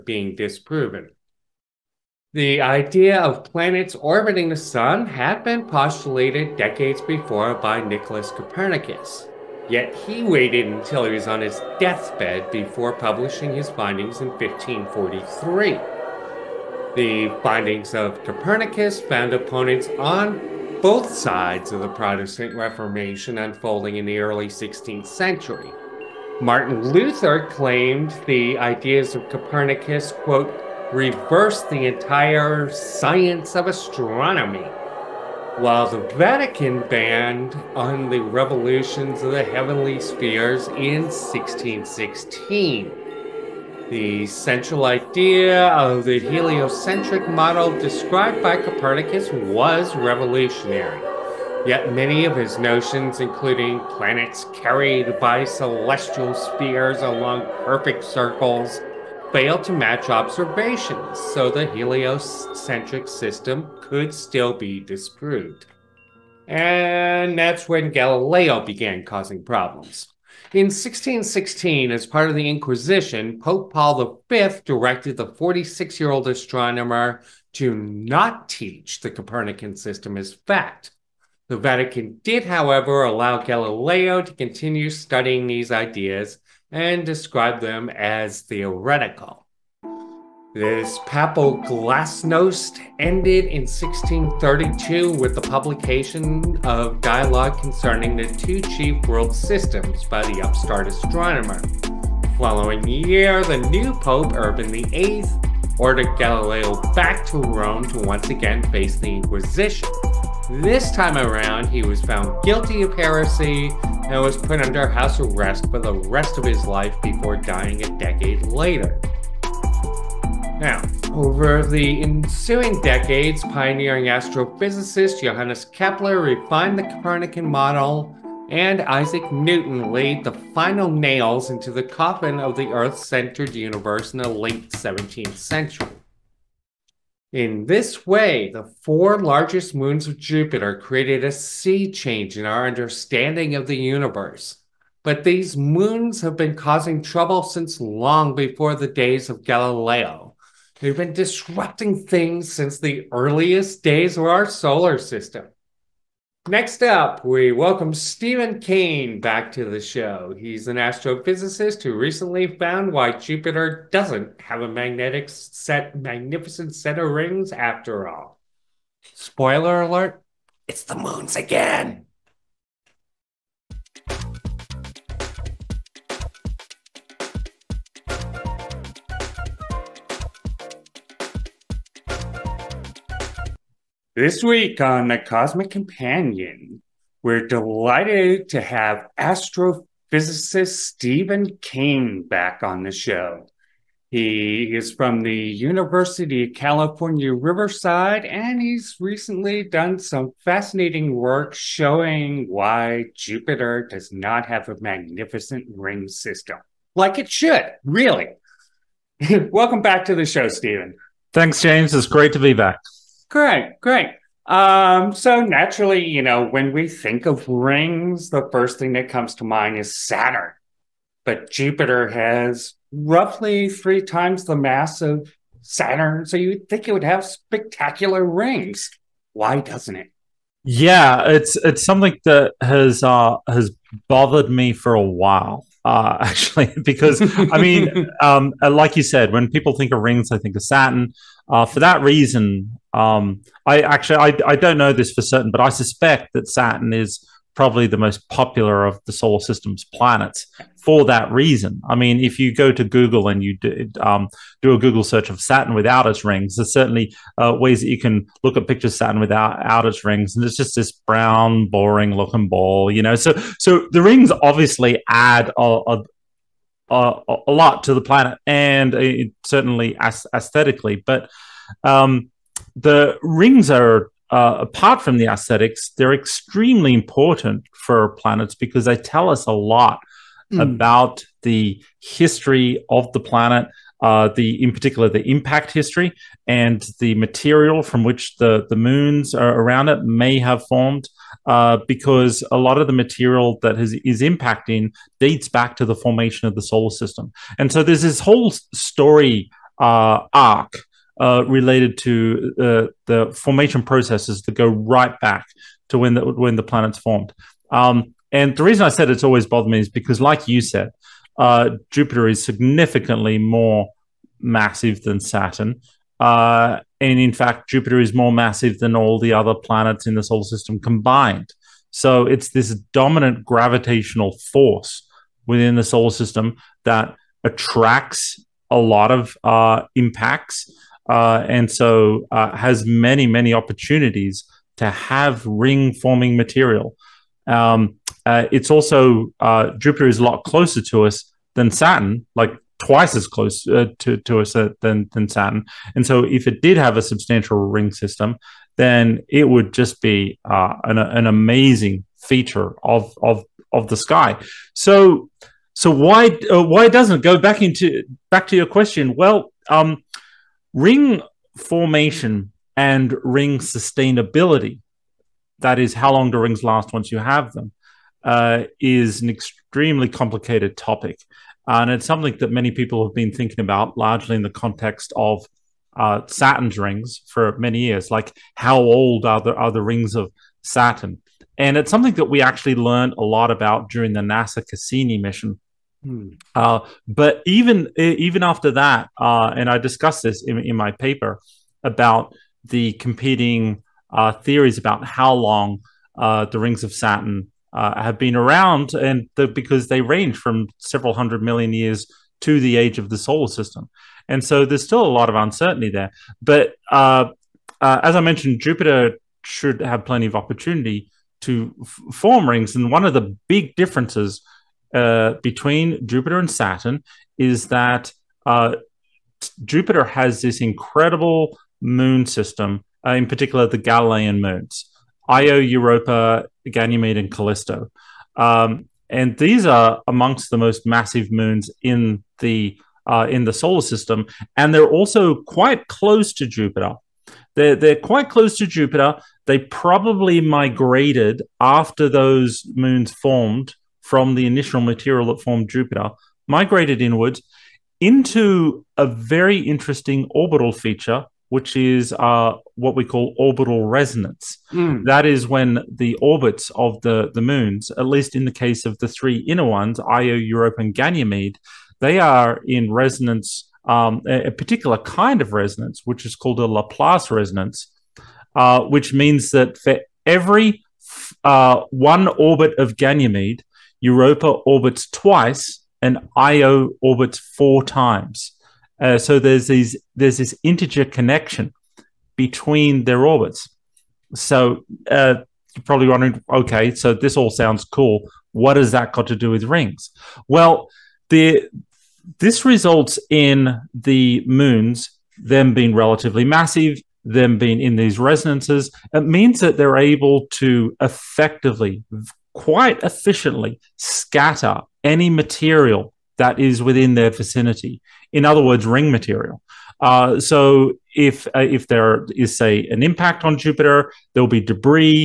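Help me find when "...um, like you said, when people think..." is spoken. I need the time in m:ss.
3:58.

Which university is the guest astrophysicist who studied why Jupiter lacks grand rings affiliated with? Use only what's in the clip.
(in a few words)
University of California, Riverside.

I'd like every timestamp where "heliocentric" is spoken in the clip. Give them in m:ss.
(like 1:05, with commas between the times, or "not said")
0:46, 1:01.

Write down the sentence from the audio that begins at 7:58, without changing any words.
Uh, so there's these there's this integer connection between their orbits.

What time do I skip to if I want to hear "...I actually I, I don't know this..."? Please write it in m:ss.
4:03.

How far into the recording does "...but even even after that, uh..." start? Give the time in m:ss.
6:27.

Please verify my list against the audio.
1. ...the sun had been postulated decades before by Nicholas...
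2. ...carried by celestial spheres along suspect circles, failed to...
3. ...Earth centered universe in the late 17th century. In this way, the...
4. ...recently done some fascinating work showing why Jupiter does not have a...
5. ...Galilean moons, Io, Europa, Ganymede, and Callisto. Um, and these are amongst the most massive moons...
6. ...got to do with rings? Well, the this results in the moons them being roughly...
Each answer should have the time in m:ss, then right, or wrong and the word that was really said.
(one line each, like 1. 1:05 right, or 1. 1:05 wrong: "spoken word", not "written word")
1. 0:04 right
2. 0:54 wrong: "perfect", not "suspect"
3. 2:12 right
4. 3:18 right
5. 7:03 right
6. 8:09 wrong: "relatively", not "roughly".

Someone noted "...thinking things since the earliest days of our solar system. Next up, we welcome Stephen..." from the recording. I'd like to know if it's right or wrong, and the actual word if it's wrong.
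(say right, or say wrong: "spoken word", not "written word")
wrong: "disrupting", not "thinking".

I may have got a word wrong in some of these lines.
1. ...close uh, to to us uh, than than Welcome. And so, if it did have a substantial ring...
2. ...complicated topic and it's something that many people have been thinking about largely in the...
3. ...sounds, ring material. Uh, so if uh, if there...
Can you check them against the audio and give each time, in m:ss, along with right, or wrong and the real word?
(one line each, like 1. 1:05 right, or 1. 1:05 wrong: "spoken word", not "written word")
1. 5:43 wrong: "Saturn", not "Welcome"
2. 6:10 right
3. 8:28 wrong: "words", not "sounds".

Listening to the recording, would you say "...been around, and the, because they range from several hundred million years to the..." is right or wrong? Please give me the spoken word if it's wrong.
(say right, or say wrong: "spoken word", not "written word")
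right.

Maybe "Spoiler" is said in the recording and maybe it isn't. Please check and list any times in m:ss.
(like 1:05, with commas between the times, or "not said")
2:49.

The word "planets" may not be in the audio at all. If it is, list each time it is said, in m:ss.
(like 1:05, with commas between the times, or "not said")
0:03, 0:53, 4:09, 4:28, 4:38, 4:43, 5:06, 5:19.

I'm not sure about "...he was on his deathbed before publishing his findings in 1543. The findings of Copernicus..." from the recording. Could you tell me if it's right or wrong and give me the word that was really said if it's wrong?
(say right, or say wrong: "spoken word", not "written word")
right.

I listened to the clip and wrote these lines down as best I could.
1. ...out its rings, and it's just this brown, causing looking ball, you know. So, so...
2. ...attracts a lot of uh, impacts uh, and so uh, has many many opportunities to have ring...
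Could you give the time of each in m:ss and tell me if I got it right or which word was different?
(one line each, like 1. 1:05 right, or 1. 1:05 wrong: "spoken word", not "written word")
1. 4:19 wrong: "boring", not "causing"
2. 5:27 right.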